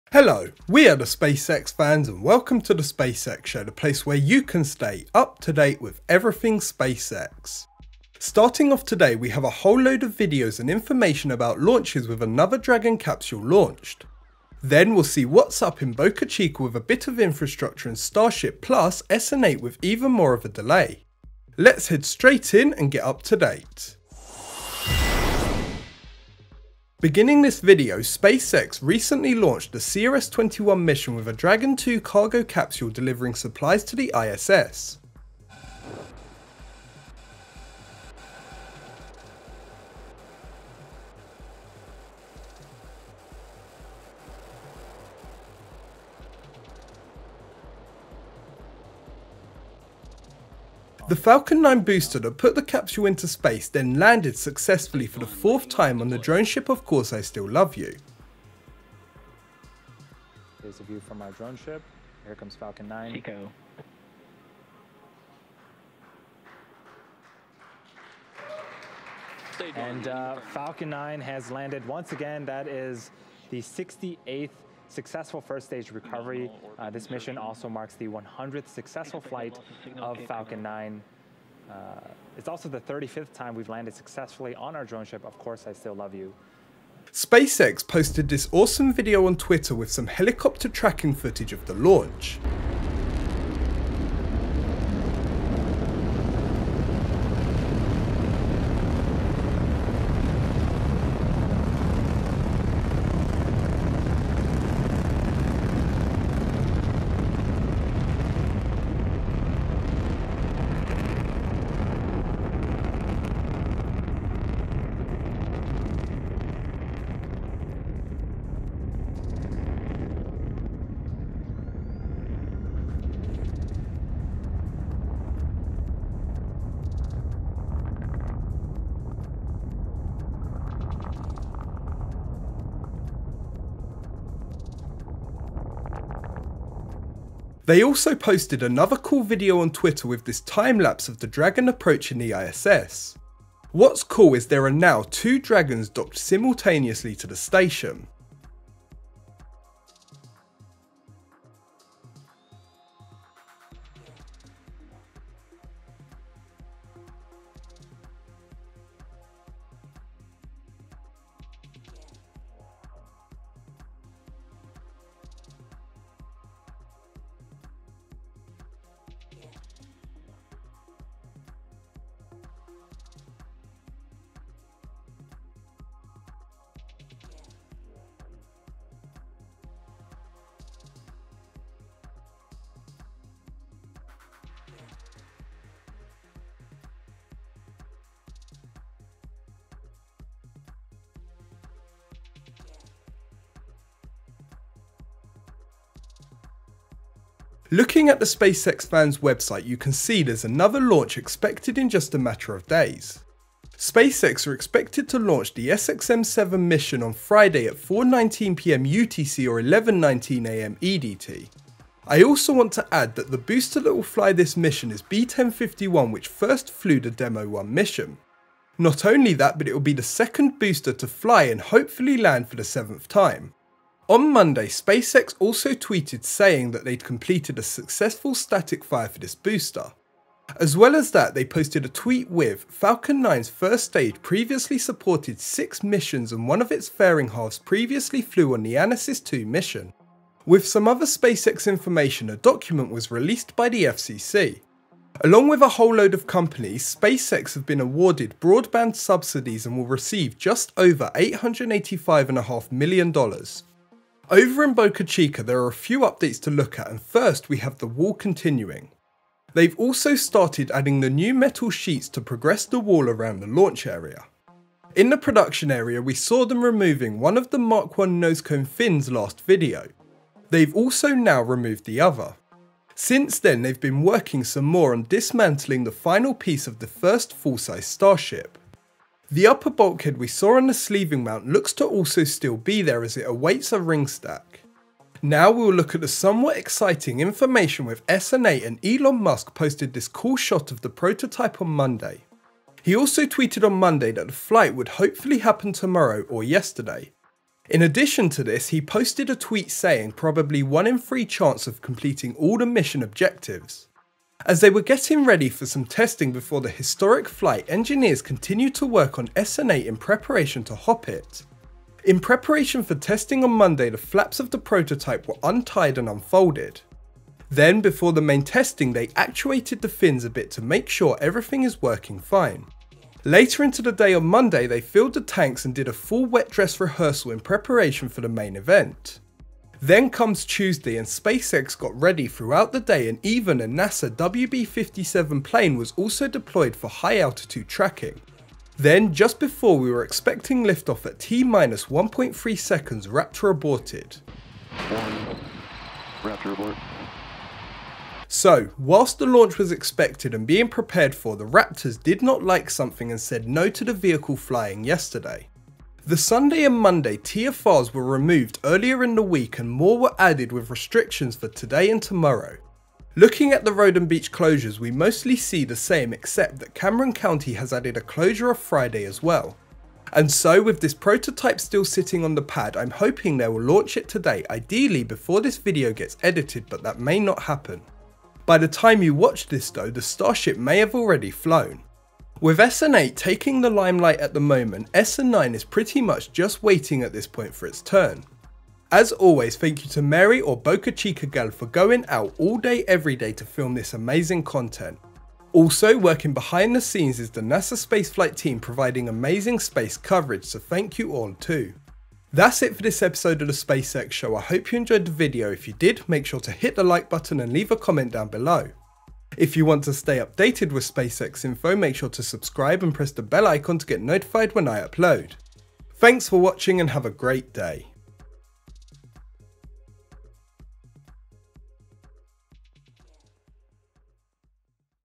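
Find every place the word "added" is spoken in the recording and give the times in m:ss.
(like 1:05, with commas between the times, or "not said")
6:00, 6:07.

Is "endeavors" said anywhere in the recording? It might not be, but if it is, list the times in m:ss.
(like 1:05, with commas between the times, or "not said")
not said.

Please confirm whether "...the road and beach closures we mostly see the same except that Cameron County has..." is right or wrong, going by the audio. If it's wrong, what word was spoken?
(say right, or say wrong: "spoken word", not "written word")
right.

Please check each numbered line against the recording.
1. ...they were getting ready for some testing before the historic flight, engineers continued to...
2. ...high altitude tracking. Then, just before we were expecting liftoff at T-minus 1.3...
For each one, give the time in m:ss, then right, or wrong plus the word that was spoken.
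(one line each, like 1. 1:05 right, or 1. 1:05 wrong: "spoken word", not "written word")
1. 5:04 right
2. 5:36 right.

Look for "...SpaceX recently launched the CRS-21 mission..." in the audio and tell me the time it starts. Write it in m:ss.
0:28.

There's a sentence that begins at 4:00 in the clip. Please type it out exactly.
With some other SpaceX information, a document was released by the FCC.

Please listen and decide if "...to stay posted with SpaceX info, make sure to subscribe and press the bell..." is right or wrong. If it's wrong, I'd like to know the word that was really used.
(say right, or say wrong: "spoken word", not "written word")
wrong: "updated", not "posted".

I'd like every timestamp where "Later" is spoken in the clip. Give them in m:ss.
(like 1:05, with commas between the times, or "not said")
5:23.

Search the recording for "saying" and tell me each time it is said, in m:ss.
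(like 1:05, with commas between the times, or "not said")
3:46, 4:59.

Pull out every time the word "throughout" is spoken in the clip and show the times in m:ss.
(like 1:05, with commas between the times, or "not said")
5:32.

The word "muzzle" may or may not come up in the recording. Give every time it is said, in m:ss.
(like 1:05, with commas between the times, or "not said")
not said.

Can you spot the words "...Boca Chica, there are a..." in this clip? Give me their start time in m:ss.
4:14.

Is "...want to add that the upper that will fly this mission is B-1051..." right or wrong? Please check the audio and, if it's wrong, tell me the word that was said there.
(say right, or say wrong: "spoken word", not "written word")
wrong: "booster", not "upper".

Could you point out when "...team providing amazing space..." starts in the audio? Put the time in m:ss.
6:38.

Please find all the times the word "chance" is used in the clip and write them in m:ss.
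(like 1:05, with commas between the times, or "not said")
5:01.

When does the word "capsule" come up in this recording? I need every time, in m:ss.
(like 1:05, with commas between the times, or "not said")
0:12, 0:32, 0:52.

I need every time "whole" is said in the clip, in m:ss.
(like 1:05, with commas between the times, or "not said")
0:09, 4:05.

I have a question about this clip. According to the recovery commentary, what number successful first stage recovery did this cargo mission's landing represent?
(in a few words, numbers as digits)
68th.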